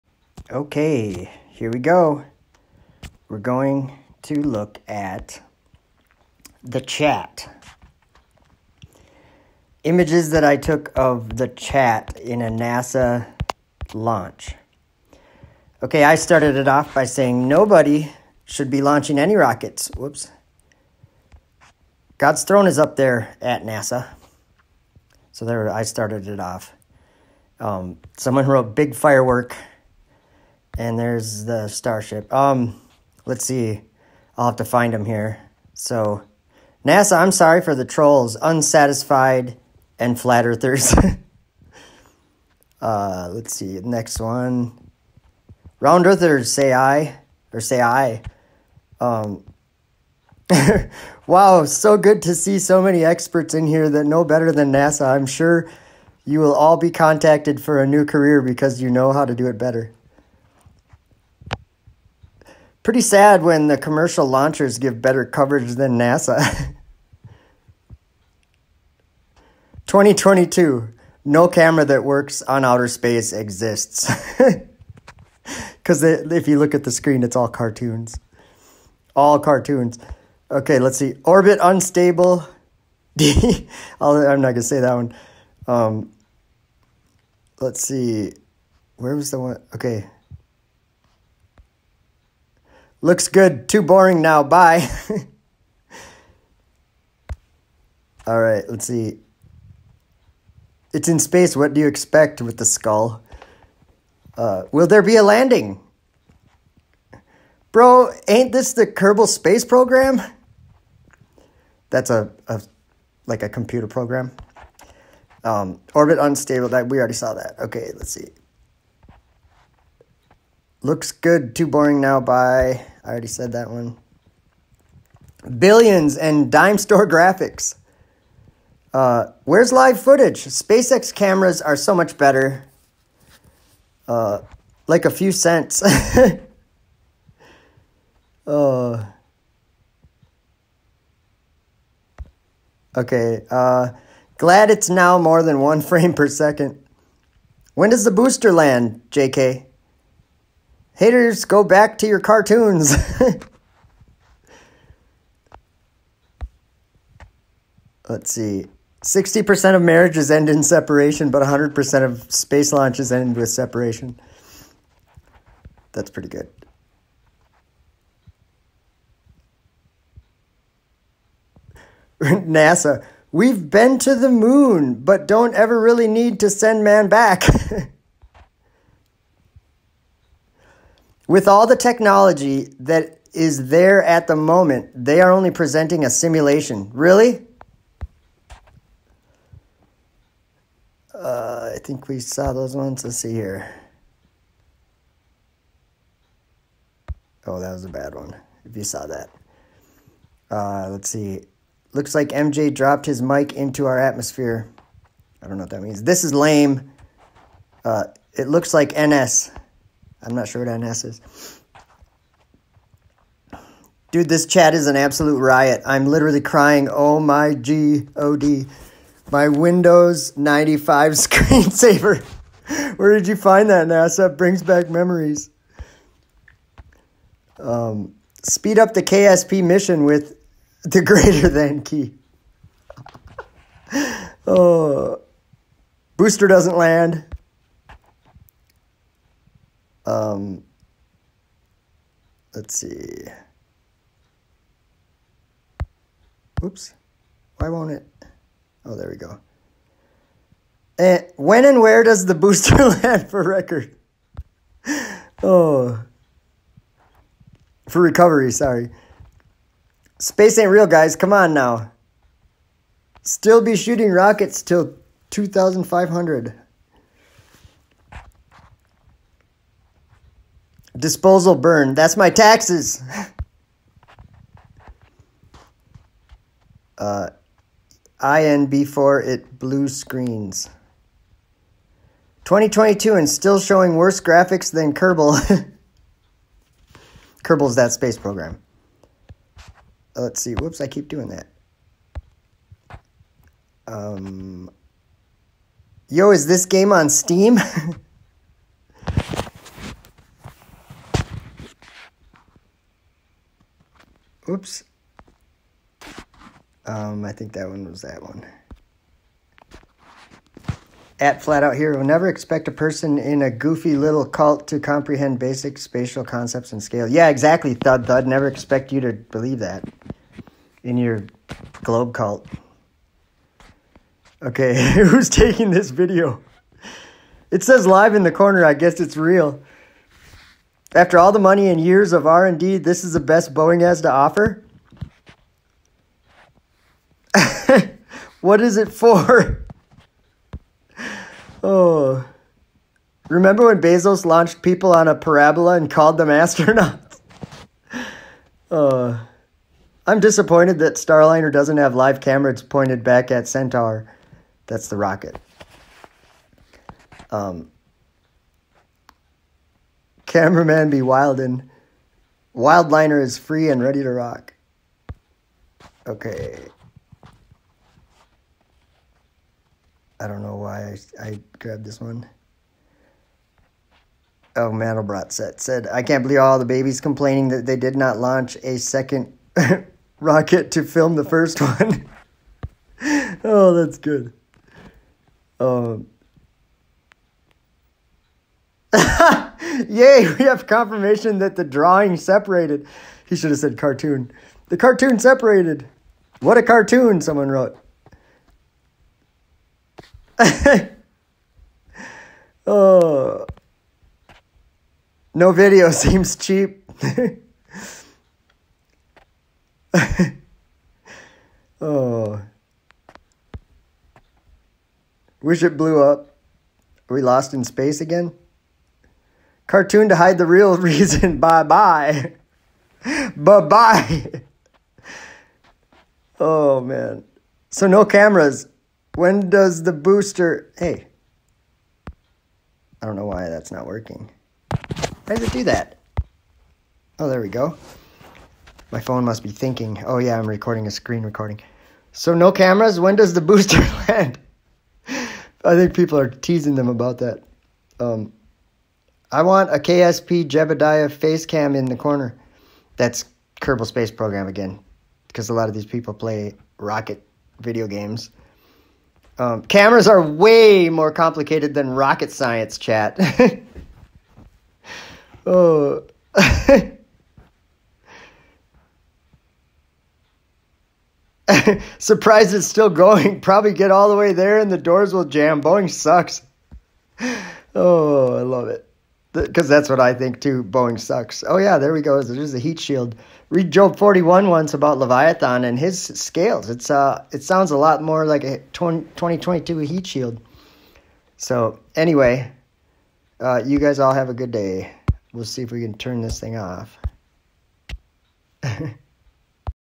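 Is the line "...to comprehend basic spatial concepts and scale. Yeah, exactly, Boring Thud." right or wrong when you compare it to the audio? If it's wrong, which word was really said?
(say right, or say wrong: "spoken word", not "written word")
wrong: "Thud", not "Boring".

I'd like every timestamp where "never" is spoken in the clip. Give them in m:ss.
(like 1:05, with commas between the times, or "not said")
5:12, 5:18.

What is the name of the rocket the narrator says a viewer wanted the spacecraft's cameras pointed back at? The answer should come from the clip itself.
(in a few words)
Centaur.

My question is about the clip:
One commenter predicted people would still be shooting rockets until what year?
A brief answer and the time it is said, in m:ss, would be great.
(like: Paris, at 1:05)
2500, at 4:25.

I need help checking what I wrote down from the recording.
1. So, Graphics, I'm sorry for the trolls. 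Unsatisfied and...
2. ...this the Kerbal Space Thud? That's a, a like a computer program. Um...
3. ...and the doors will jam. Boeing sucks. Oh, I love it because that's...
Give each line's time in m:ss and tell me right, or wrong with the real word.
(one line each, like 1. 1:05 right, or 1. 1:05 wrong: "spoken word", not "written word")
1. 0:35 wrong: "NASA", not "Graphics"
2. 1:48 wrong: "Program", not "Thud"
3. 7:54 right.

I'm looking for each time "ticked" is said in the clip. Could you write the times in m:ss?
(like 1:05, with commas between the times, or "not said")
not said.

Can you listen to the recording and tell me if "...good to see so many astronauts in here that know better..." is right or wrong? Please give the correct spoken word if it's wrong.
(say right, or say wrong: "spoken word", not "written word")
wrong: "experts", not "astronauts".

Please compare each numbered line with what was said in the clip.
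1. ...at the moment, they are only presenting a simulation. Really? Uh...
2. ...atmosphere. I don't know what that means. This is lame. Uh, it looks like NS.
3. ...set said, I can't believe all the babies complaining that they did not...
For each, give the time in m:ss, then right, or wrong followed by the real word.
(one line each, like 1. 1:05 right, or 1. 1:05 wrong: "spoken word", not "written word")
1. 3:04 right
2. 3:23 right
3. 6:15 right.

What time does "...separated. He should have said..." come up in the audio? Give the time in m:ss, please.
6:32.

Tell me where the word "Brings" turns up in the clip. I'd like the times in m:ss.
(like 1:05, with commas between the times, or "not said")
3:44.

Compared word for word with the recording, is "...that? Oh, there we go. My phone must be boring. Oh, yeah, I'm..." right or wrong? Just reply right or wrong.
wrong.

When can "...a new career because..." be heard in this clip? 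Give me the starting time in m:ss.
0:57.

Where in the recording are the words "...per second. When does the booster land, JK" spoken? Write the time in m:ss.
2:26.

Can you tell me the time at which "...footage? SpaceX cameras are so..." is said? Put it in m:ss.
2:10.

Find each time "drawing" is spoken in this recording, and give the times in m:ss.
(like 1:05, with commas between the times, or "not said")
6:31.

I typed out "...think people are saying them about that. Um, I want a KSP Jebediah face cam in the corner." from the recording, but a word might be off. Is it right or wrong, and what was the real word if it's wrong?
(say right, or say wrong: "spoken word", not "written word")
wrong: "teasing", not "saying".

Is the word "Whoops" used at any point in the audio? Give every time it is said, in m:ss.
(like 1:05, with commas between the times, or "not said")
0:19, 4:50.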